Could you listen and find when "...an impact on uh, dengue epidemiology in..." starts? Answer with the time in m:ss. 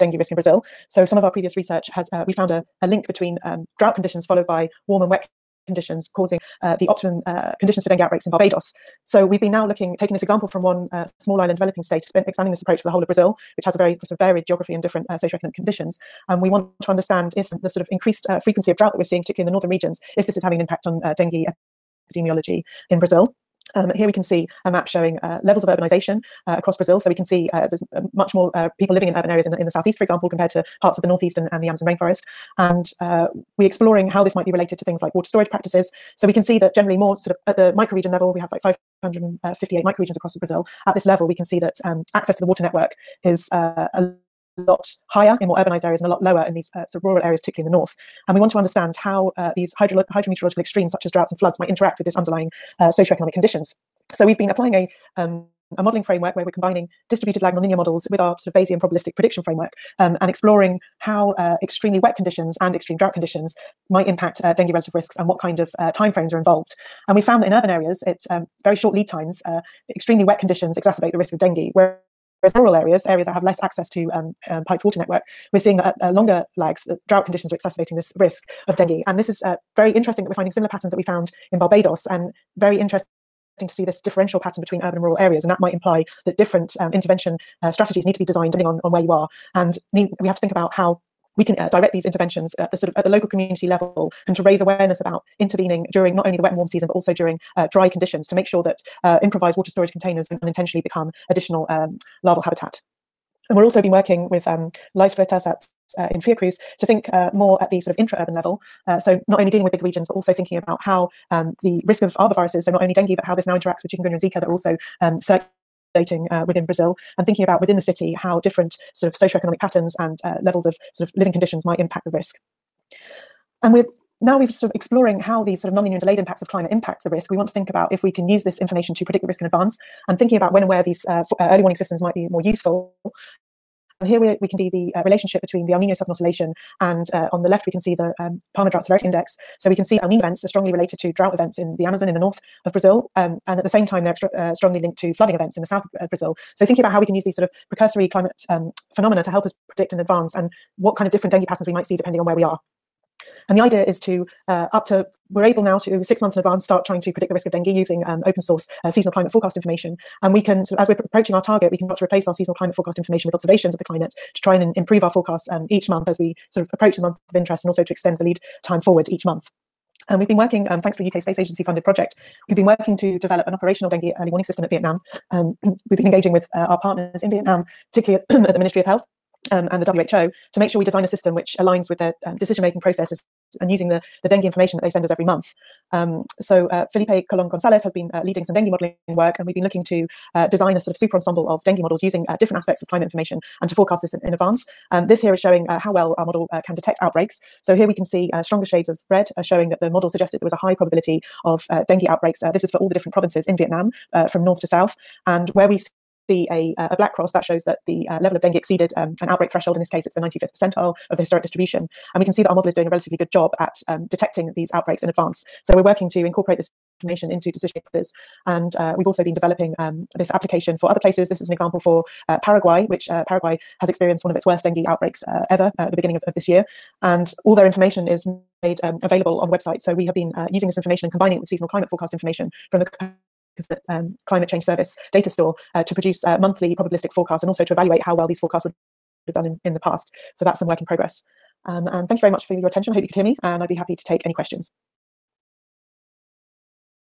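0:20.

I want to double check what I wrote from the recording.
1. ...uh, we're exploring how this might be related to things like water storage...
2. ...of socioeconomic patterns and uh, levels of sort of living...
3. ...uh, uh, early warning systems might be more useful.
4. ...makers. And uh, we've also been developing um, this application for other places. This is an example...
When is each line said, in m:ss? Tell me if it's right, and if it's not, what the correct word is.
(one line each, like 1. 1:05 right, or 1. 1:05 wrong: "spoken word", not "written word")
1. 0:32 right
2. 1:59 right
3. 2:11 right
4. 3:37 right.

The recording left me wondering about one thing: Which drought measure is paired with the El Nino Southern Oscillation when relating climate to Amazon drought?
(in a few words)
Palmer Drought Severity Index.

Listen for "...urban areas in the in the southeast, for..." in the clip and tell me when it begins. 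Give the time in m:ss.
0:29.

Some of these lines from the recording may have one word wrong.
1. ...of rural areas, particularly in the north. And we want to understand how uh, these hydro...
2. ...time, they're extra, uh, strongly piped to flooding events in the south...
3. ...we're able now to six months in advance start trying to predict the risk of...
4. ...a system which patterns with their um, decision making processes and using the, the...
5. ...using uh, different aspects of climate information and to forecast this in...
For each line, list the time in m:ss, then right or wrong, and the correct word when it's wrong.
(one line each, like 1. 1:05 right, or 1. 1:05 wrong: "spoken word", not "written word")
1. 0:47 right
2. 2:23 wrong: "linked", not "piped"
3. 2:35 right
4. 3:01 wrong: "aligns", not "patterns"
5. 3:12 right.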